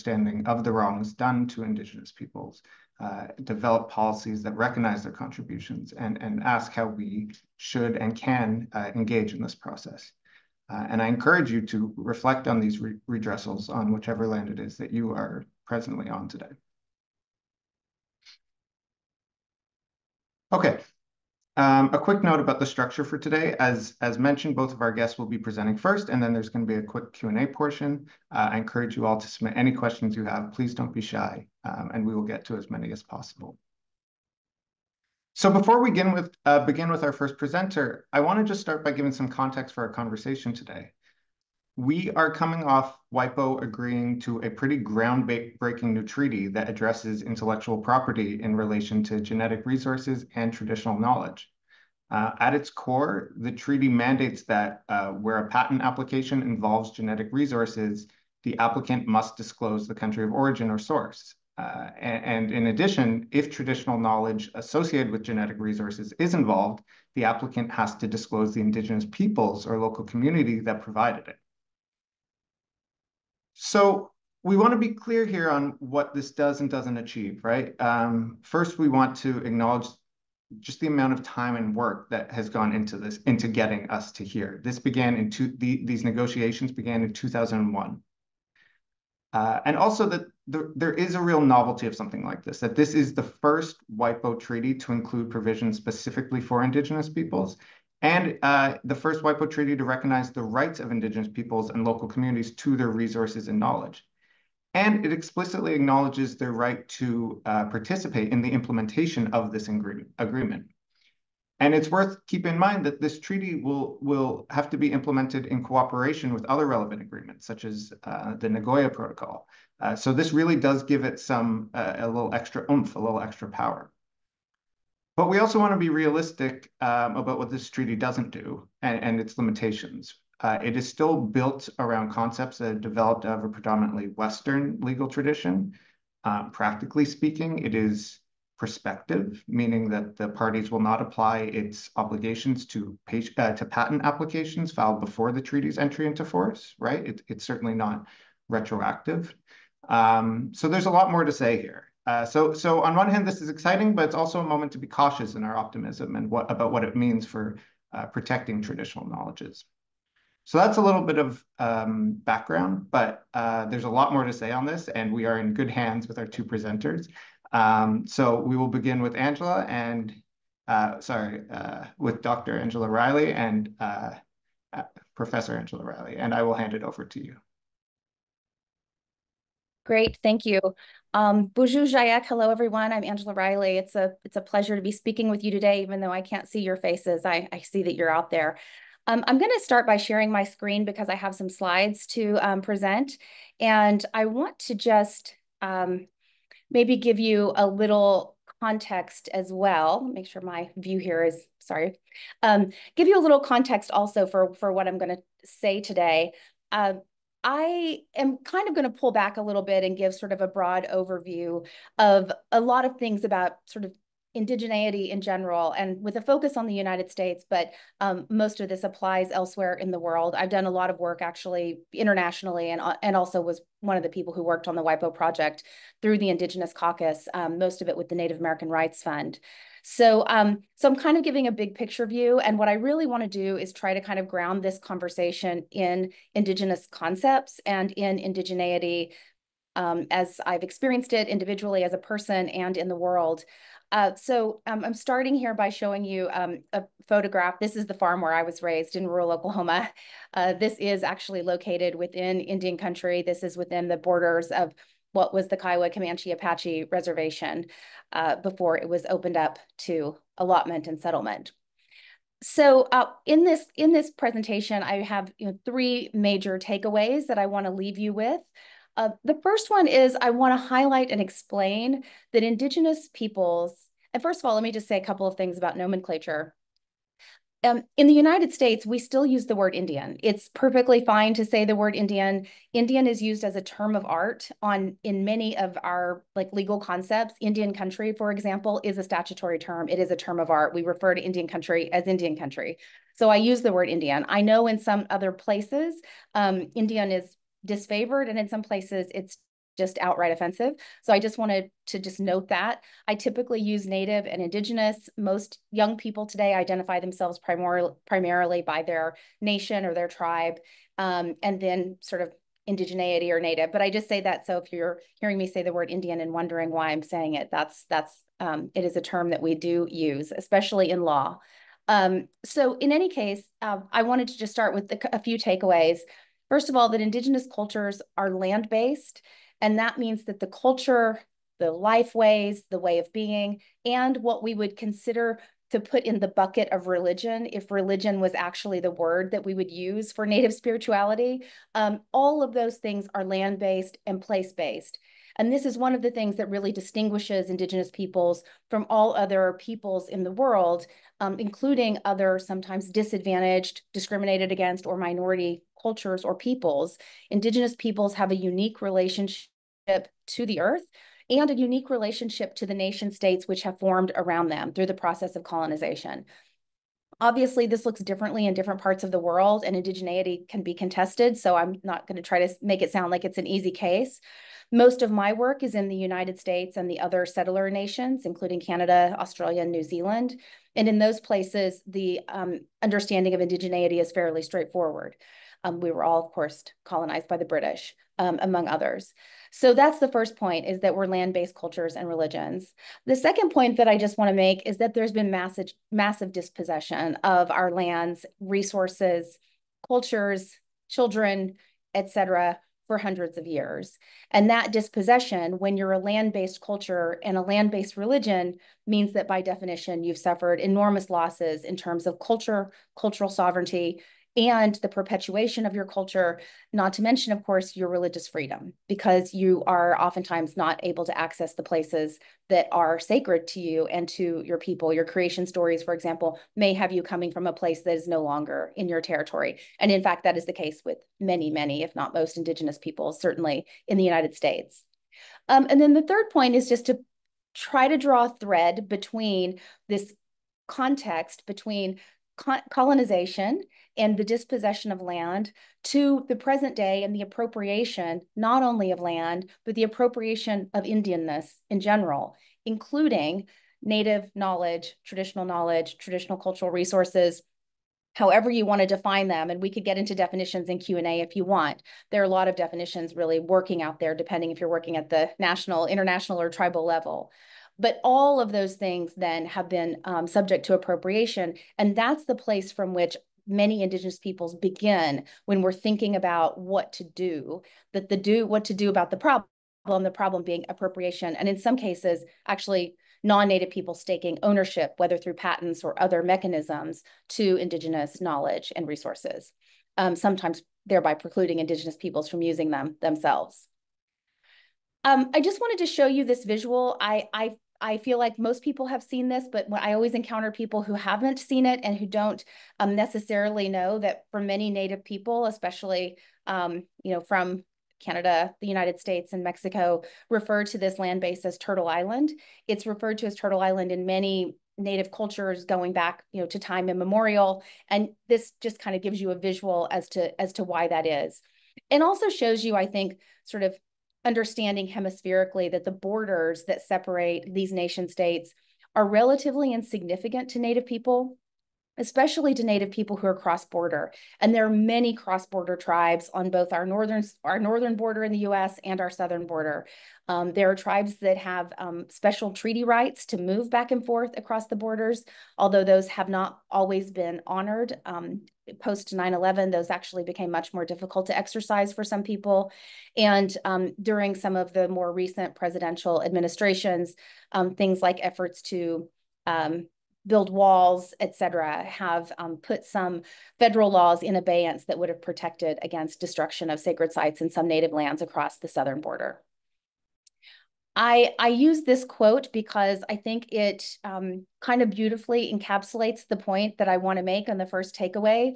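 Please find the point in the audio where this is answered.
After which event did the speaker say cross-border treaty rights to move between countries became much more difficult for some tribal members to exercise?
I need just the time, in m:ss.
9:09.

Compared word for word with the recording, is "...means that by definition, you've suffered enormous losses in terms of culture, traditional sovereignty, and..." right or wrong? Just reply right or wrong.
wrong.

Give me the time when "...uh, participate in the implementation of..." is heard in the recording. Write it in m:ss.
1:47.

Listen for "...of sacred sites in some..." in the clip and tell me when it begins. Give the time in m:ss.
9:26.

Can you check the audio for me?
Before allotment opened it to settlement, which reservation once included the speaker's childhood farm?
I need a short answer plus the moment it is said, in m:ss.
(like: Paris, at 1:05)
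Kiowa Comanche Apache Reservation, at 4:15.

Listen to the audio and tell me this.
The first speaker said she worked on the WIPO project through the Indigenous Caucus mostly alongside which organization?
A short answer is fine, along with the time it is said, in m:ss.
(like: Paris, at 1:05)
Native American Rights Fund, at 3:48.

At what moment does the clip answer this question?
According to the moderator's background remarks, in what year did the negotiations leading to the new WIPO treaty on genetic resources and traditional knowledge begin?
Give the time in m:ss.
1:27.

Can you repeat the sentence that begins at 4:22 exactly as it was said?
So uh, in this in this presentation, I have you know, three major takeaways that I want to leave you with.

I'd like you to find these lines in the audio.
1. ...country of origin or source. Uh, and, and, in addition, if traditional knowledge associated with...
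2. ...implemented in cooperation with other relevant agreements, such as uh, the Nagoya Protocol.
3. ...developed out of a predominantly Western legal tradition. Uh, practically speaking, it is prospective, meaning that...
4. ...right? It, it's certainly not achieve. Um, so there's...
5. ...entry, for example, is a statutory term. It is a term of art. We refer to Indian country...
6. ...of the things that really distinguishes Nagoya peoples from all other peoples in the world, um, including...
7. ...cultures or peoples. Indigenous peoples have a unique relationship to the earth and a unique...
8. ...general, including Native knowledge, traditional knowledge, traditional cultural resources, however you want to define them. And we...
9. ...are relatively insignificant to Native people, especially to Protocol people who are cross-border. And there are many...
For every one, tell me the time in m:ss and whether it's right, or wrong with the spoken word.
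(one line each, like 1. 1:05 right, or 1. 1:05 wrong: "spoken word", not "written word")
1. 0:59 right
2. 1:54 right
3. 2:12 right
4. 2:26 wrong: "retroactive", not "achieve"
5. 4:47 wrong: "country", not "entry"
6. 5:45 wrong: "Indigenous", not "Nagoya"
7. 5:55 right
8. 7:31 right
9. 8:48 wrong: "Native", not "Protocol".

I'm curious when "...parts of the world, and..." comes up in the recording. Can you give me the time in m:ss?
6:08.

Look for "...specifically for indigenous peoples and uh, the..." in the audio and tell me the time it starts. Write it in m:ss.
1:35.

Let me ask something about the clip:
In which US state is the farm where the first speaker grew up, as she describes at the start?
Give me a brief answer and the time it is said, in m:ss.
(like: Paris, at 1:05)
Oklahoma, at 4:09.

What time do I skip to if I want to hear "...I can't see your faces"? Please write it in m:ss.
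3:06.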